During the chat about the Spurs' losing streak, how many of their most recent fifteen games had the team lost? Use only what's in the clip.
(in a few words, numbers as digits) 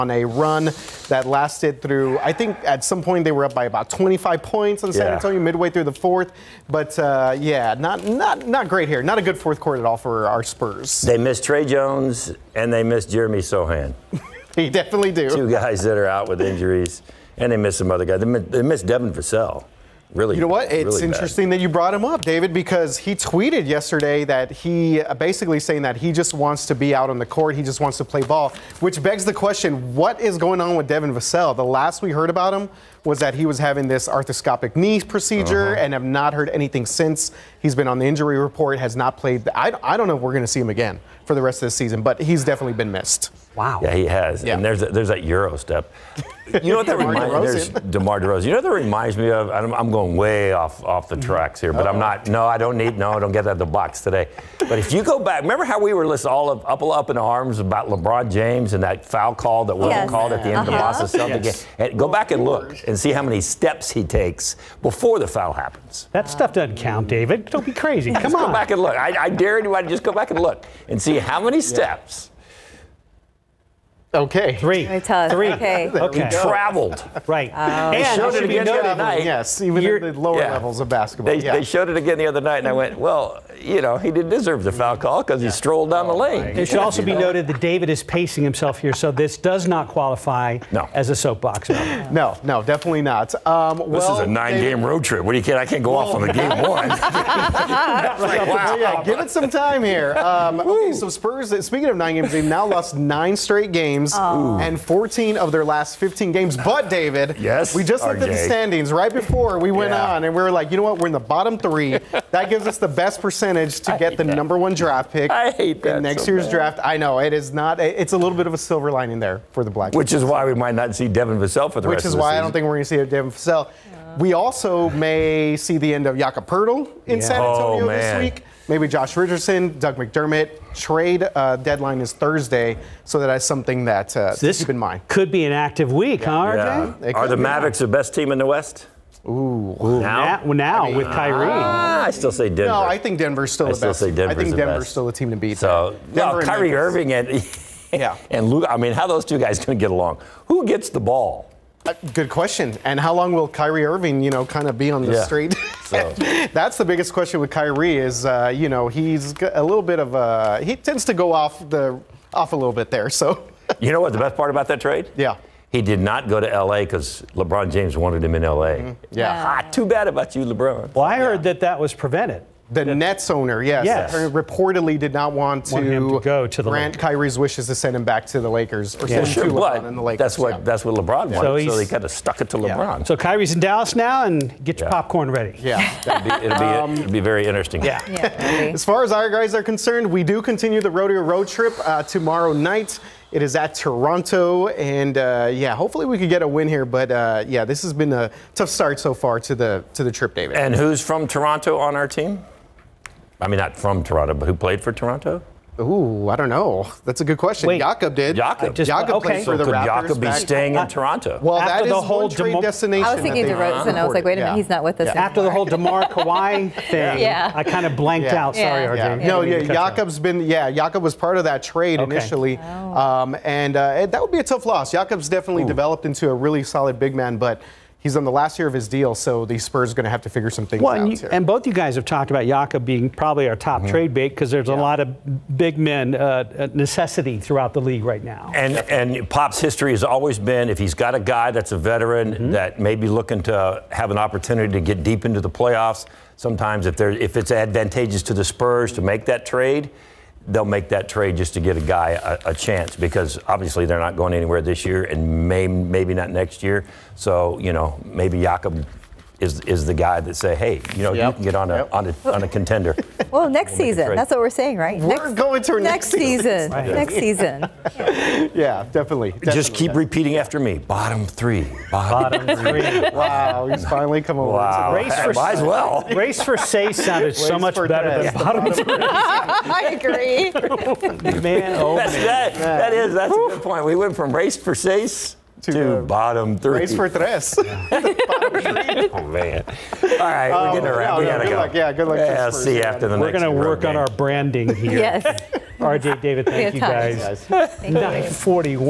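14.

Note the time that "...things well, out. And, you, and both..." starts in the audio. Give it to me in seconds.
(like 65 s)
230 s.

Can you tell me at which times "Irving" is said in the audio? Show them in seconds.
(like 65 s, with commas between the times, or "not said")
146 s, 153 s.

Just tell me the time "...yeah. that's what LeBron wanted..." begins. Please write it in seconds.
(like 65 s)
180 s.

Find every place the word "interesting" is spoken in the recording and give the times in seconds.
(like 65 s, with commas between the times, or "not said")
21 s, 187 s.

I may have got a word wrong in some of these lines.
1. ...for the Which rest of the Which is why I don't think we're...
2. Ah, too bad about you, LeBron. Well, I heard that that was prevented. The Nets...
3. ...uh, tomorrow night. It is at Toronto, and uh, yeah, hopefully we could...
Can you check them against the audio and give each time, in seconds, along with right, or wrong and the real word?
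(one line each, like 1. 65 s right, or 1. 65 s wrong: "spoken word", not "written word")
1. 121 s right
2. 169 s right
3. 191 s right.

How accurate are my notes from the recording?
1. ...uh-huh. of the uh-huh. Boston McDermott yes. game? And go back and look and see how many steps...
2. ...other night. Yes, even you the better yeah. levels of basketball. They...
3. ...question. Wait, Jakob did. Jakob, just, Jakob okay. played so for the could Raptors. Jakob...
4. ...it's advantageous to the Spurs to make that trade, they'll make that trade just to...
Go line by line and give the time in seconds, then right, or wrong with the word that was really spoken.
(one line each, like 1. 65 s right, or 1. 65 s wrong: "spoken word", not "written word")
1. 60 s wrong: "Celtics", not "McDermott"
2. 78 s wrong: "lower", not "better"
3. 207 s right
4. 247 s right.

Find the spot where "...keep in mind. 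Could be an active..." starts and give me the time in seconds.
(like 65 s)
134 s.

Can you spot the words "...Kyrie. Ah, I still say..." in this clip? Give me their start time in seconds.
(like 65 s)
141 s.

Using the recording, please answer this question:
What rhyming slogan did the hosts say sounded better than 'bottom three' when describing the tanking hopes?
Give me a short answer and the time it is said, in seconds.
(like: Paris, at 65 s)
Race for sace, at 276 s.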